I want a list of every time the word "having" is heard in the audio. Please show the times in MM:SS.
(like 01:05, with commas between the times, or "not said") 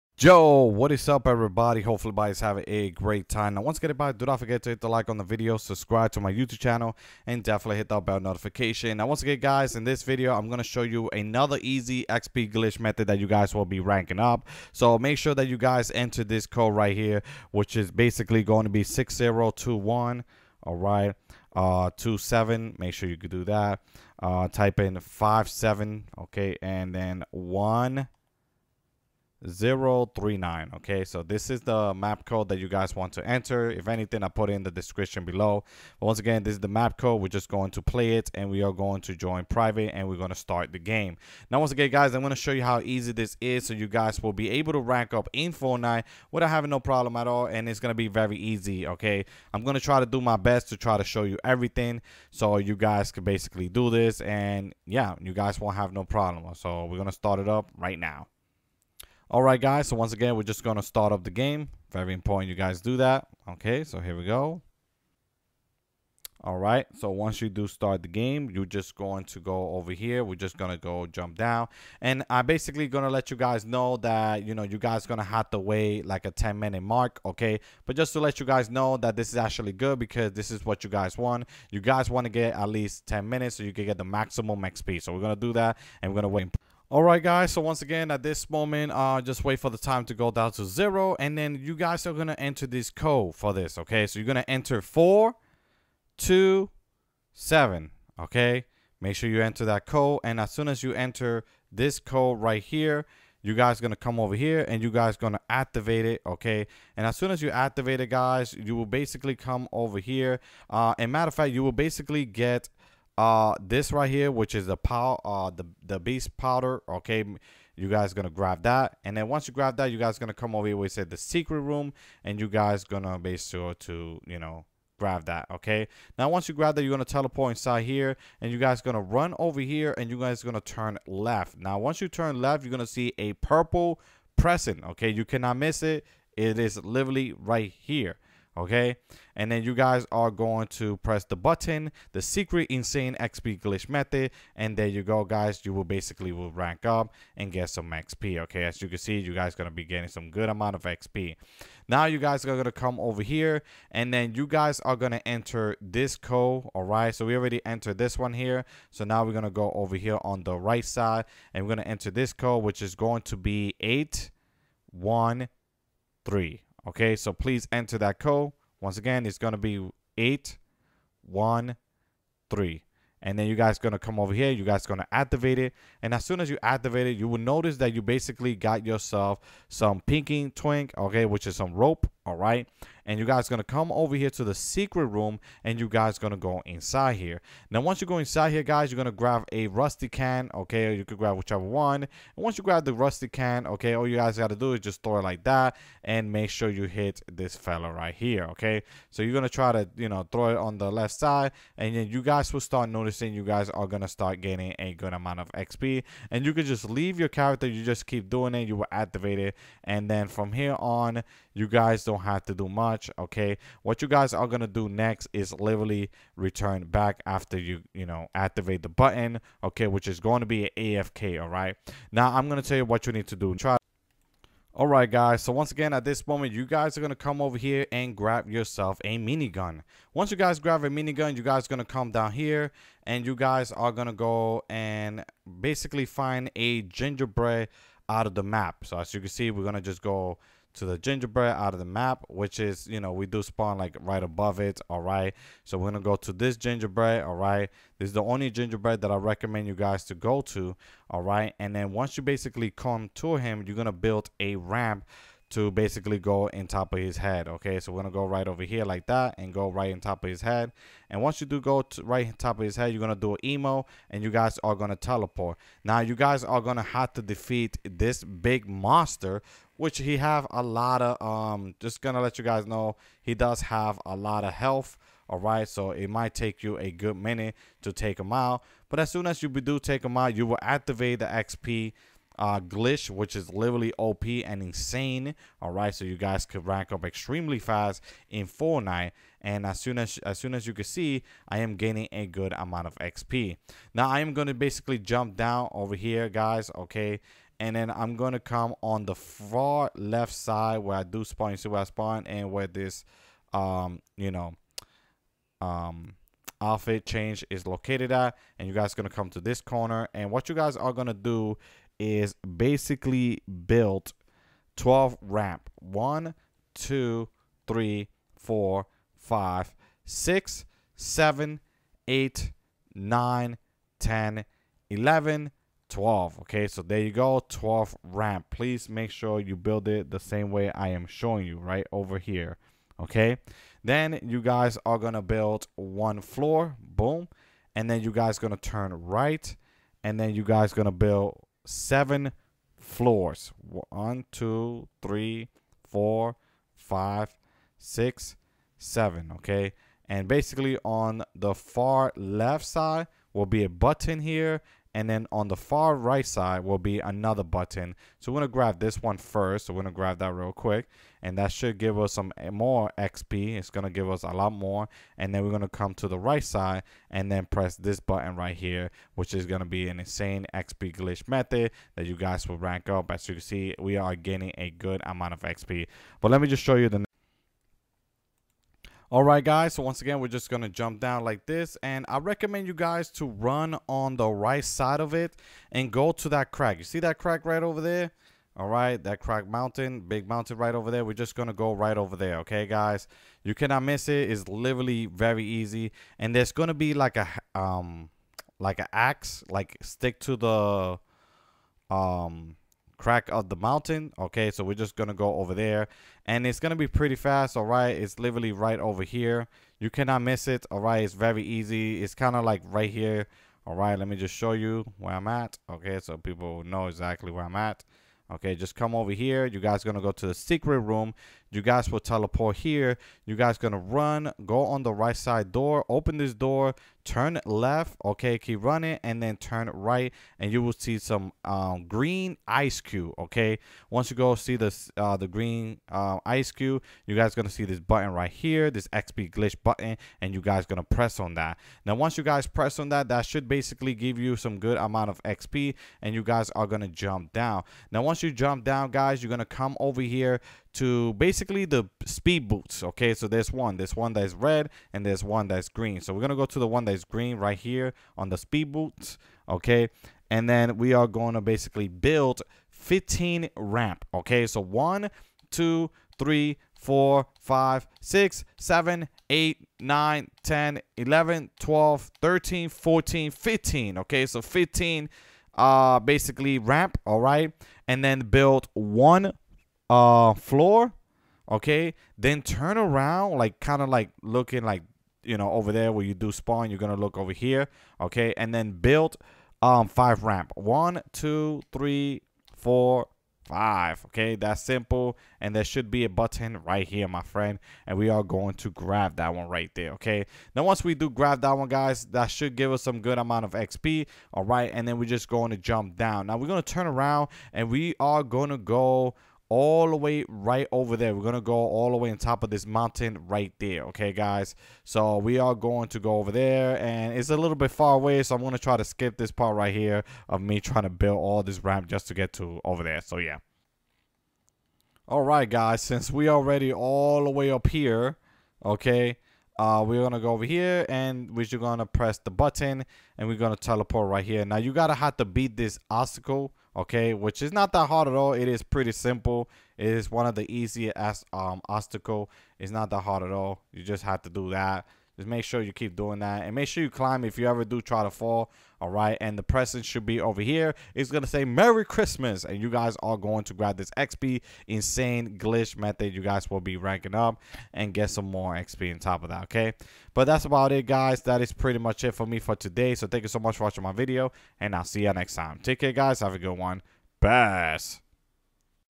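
00:02, 00:46.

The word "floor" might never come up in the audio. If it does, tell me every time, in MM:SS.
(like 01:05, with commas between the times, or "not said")
05:36, 05:42, 08:00.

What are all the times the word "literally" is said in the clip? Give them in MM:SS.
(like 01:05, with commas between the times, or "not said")
02:16, 03:35, 04:43, 06:34, 06:48.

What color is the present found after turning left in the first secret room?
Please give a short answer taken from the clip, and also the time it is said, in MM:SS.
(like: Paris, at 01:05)
purple, at 02:13.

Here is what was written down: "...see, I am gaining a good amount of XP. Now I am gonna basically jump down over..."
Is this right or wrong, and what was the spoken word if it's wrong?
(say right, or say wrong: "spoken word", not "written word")
right.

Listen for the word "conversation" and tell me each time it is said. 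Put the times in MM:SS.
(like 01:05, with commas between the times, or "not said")
not said.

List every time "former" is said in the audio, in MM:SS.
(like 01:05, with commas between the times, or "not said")
not said.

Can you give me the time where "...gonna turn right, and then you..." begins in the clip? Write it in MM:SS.
05:38.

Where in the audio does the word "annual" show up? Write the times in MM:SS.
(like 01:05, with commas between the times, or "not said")
not said.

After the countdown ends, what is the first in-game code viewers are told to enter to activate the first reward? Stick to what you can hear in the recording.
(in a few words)
427.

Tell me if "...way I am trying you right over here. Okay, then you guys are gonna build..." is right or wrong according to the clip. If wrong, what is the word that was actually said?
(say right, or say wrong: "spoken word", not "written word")
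wrong: "showing", not "trying".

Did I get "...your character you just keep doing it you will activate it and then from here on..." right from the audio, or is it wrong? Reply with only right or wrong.
right.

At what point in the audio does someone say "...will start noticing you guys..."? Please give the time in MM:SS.
03:22.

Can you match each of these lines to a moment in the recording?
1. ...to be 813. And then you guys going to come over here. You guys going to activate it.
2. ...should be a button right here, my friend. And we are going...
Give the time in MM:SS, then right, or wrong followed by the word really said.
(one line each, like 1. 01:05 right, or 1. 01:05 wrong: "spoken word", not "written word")
1. 02:49 right
2. 08:15 right.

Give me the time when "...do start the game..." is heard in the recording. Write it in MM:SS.
01:07.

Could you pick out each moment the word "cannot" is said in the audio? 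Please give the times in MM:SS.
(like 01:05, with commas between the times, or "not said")
02:15, 06:33, 06:49.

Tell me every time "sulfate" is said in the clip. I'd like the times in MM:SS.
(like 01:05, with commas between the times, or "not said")
not said.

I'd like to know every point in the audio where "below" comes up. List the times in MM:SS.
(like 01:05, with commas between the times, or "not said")
00:35.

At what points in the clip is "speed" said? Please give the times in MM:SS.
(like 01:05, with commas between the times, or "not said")
07:32, 07:38.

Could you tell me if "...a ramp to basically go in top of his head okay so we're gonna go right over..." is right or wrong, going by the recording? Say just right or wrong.
right.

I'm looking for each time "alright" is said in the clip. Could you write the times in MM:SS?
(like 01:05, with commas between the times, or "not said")
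00:20, 03:44.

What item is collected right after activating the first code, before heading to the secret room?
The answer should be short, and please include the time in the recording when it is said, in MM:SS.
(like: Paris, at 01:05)
beast powder, at 01:55.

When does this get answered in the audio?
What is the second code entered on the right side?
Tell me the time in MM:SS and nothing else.
02:43.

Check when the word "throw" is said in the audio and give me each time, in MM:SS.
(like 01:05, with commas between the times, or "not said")
03:15, 03:20.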